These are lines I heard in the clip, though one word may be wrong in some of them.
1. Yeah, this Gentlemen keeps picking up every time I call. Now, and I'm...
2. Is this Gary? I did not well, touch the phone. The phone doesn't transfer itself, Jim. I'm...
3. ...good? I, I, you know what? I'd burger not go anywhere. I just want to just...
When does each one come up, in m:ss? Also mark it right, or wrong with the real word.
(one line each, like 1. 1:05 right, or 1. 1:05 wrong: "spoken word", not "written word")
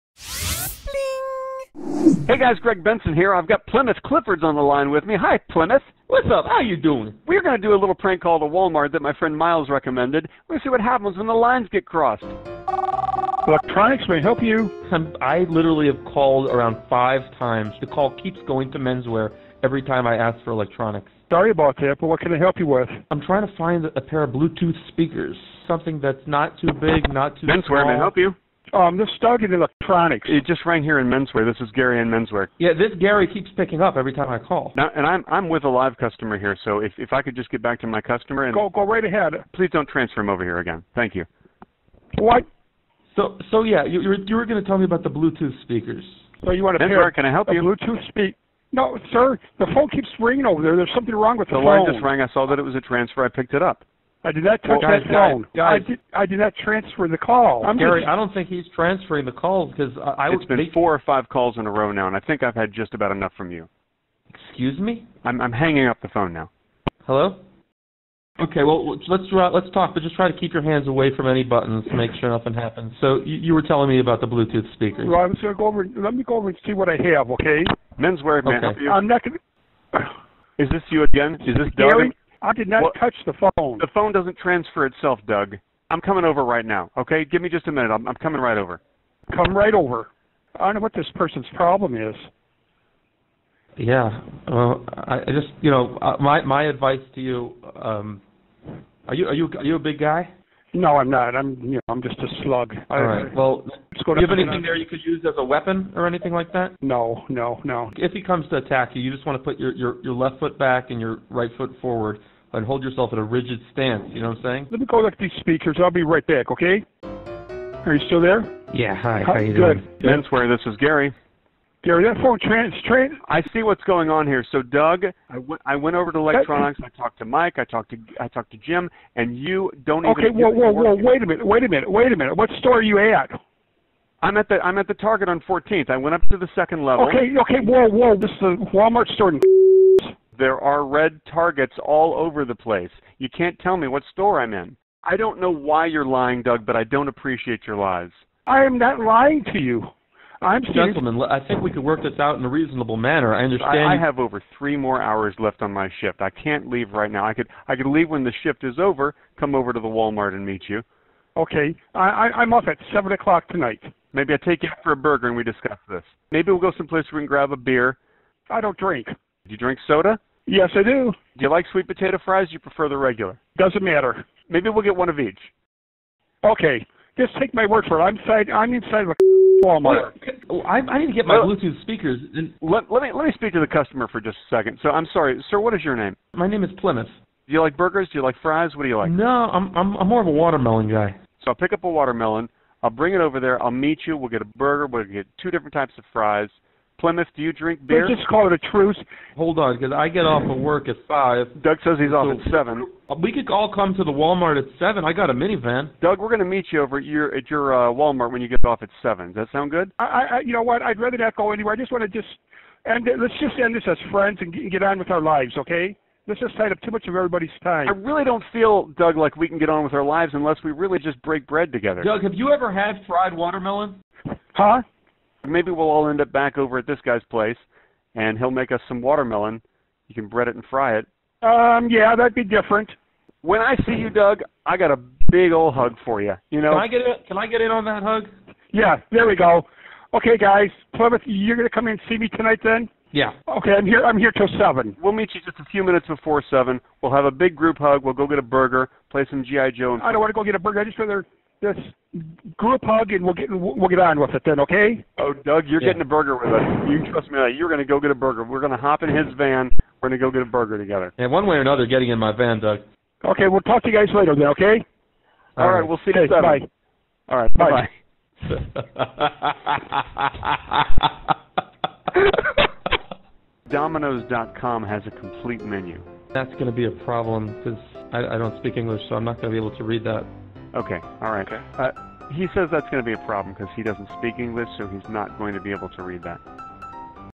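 1. 0:32 wrong: "Gary", not "Gentlemen"
2. 1:21 wrong: "Doug", not "Jim"
3. 3:29 wrong: "rather", not "burger".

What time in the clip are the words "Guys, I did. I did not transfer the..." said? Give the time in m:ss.
0:55.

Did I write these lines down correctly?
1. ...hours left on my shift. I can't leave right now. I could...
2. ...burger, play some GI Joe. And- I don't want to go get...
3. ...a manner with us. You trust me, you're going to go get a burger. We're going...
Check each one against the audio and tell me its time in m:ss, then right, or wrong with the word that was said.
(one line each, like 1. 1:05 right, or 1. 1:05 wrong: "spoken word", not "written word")
1. 2:34 right
2. 4:08 right
3. 4:16 wrong: "burger", not "manner".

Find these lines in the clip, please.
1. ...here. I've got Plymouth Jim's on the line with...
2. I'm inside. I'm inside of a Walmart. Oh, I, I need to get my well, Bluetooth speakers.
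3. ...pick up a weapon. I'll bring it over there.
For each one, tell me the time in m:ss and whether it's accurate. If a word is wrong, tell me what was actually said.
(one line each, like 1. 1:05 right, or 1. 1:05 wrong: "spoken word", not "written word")
1. 0:03 wrong: "Clifford", not "Jim"
2. 2:58 right
3. 3:11 wrong: "watermelon", not "weapon".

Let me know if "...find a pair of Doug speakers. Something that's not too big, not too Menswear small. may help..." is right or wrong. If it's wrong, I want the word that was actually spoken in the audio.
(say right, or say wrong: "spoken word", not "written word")
wrong: "Bluetooth", not "Doug".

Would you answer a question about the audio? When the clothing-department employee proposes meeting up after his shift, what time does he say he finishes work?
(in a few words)
7.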